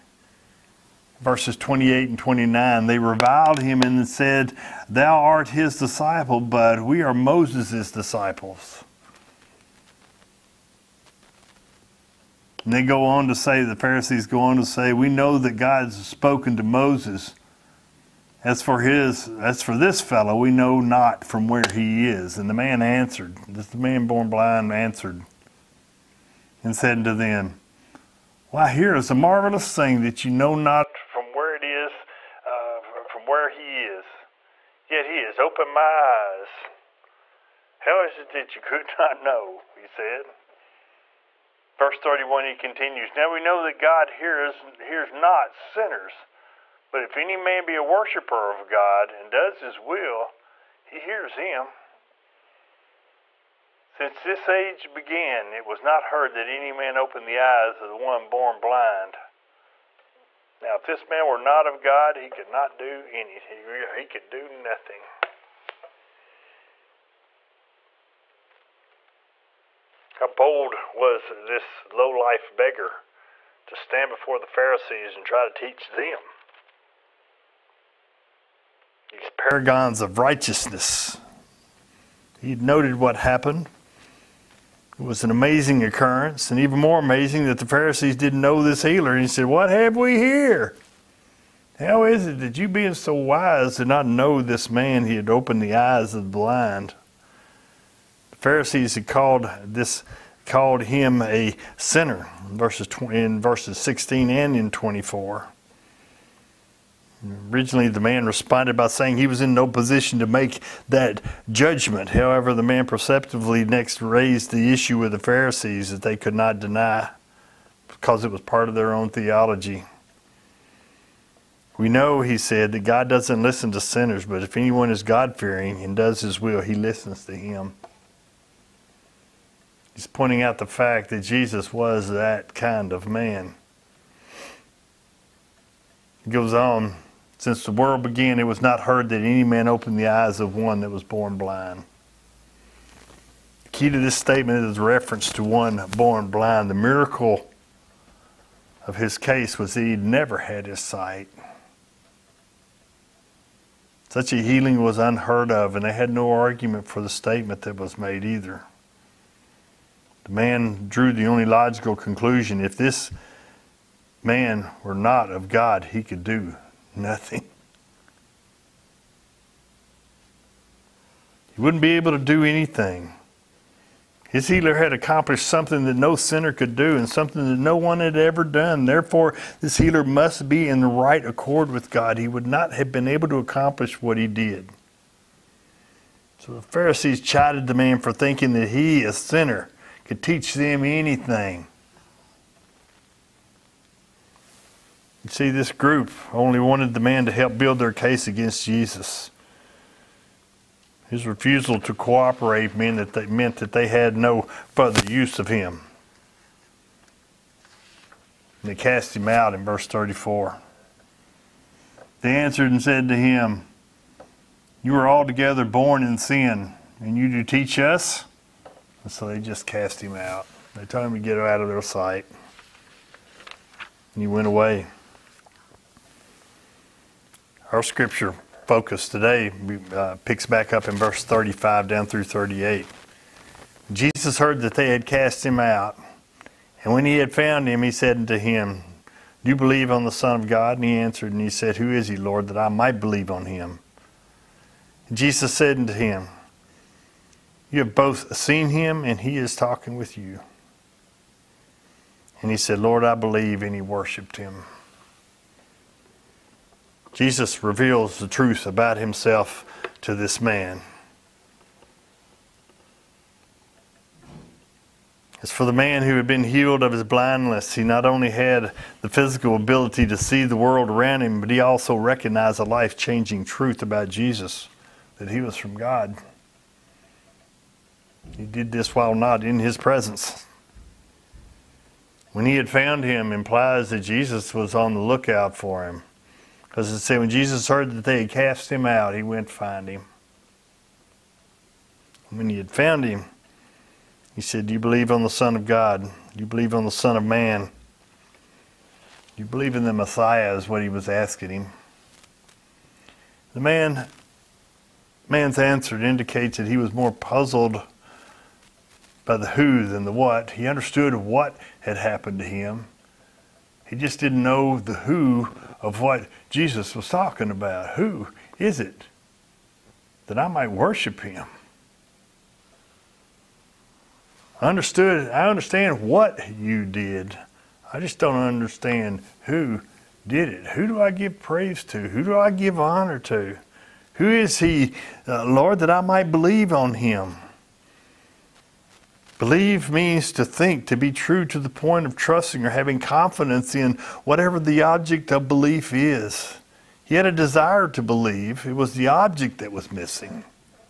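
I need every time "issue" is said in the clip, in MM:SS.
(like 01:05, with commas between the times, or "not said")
01:54.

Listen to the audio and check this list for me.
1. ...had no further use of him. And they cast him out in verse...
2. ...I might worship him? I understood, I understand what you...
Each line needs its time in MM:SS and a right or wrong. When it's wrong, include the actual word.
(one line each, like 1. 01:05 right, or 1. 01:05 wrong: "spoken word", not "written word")
1. 03:23 right
2. 05:20 right.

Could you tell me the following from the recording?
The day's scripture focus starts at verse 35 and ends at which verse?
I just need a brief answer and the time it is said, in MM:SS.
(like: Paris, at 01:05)
38, at 03:52.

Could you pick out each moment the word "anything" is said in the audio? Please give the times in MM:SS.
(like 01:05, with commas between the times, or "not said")
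01:03, 02:52, 03:10.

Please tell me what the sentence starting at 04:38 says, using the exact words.
He did this while not in his presence.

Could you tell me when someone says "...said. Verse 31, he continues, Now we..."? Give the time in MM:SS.
00:39.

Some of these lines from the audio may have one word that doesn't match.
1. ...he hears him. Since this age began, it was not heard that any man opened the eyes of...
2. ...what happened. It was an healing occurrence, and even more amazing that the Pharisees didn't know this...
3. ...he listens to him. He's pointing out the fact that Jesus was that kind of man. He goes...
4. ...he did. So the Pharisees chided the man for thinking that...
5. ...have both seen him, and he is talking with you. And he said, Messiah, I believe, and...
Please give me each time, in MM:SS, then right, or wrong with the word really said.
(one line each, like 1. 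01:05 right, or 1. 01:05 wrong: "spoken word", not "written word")
1. 00:50 right
2. 01:22 wrong: "amazing", not "healing"
3. 02:06 right
4. 03:04 right
5. 04:07 wrong: "Lord", not "Messiah".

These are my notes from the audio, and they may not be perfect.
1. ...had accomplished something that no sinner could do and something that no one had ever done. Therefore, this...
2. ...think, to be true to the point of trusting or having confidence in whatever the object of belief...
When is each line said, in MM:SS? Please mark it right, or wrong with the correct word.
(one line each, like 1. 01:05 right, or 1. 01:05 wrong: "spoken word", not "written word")
1. 02:54 right
2. 05:40 right.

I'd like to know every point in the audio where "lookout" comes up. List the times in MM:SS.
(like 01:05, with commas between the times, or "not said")
04:44.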